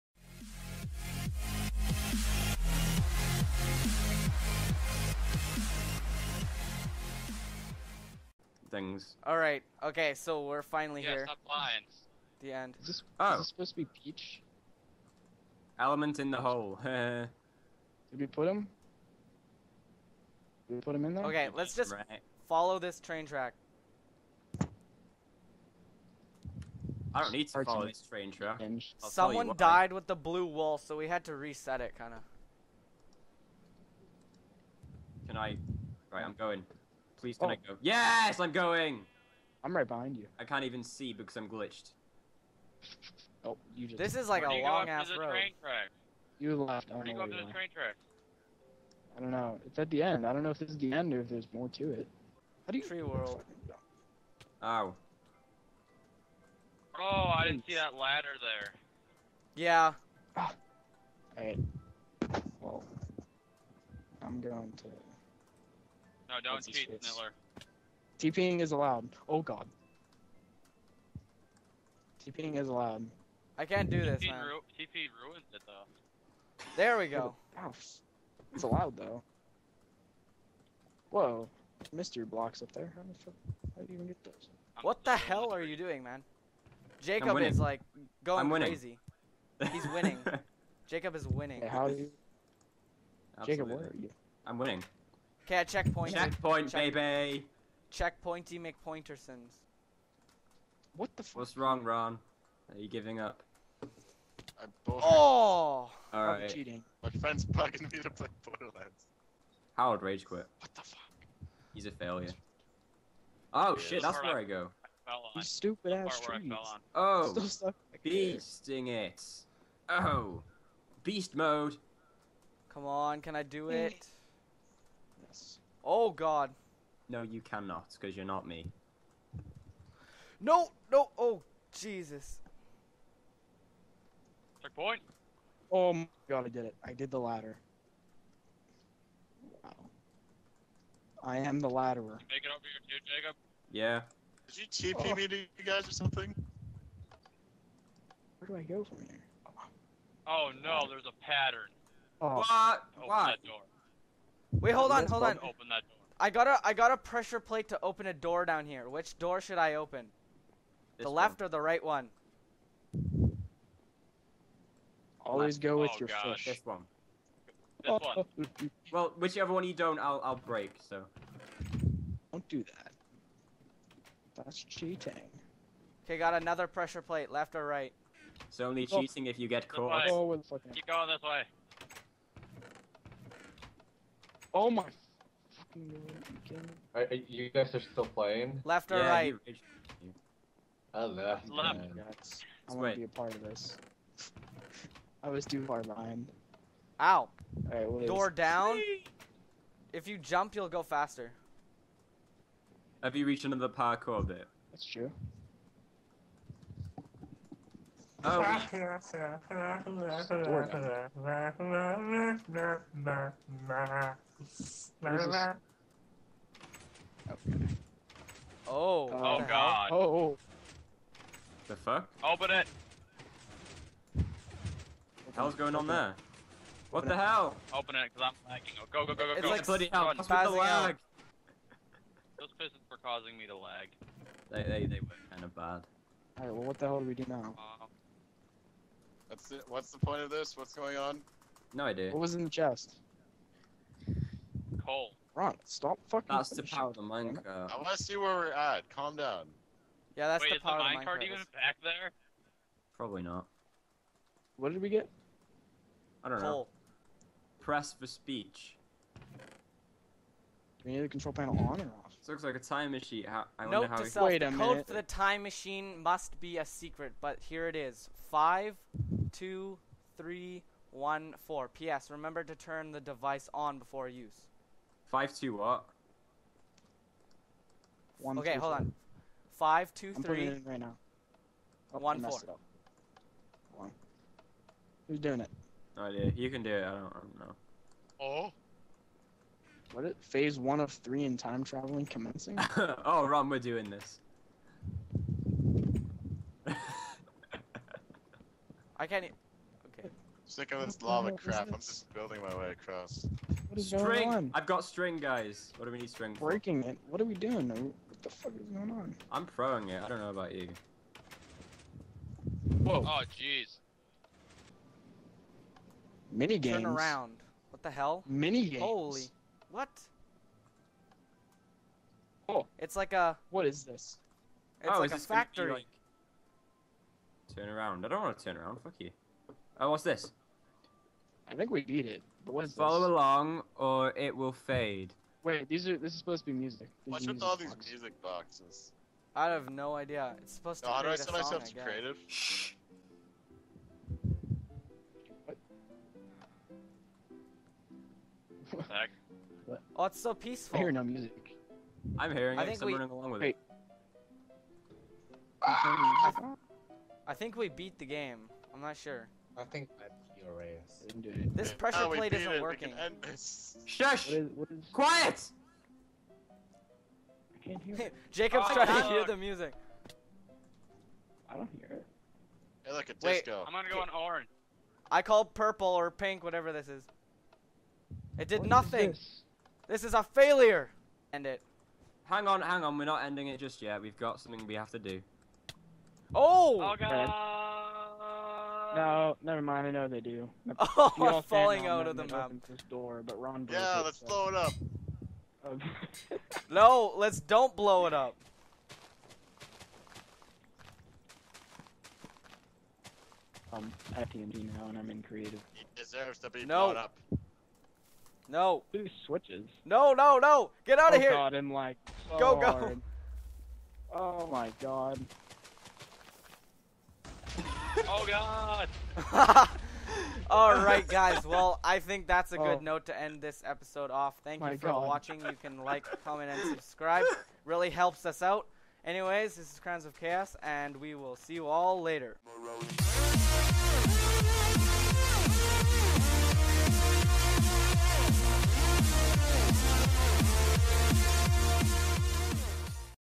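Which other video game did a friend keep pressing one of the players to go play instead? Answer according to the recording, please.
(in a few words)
Borderlands.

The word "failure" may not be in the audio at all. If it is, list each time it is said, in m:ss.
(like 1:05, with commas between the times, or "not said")
1:51, 6:20.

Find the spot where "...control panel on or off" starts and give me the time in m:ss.
4:21.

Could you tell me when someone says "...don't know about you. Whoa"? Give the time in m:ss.
5:10.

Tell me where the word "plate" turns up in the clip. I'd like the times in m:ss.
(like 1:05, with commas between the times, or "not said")
2:37, 2:57, 6:02.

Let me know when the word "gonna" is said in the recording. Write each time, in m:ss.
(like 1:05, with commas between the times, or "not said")
6:13.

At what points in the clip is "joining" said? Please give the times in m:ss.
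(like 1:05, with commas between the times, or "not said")
not said.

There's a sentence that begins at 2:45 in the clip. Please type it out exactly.
Always go with oh, your gosh.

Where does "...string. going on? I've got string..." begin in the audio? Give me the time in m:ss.
5:03.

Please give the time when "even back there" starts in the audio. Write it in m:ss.
4:11.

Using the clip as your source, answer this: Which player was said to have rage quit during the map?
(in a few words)
Howard.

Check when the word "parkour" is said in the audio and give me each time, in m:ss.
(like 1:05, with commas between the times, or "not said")
3:23.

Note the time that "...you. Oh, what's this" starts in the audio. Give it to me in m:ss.
5:28.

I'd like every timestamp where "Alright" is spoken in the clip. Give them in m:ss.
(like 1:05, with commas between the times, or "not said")
1:01, 3:56.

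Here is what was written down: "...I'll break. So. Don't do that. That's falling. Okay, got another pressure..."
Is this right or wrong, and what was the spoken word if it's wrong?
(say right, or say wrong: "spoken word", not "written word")
wrong: "cheating", not "falling".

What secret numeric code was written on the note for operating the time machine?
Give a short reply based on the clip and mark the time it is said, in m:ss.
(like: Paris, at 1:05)
52314, at 4:28.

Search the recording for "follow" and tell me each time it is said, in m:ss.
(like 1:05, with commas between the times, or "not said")
0:22, 0:27, 5:32.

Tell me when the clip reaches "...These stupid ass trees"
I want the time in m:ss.
1:55.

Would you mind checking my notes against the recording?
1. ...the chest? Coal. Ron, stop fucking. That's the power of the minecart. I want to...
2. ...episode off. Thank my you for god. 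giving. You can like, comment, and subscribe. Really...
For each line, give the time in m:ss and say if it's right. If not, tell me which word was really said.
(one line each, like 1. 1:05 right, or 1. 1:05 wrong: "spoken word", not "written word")
1. 4:02 right
2. 7:03 wrong: "watching", not "giving".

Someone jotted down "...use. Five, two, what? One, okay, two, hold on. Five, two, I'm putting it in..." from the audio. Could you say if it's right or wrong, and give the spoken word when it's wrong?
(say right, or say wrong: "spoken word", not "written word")
right.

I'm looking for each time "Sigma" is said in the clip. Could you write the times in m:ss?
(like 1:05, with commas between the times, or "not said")
not said.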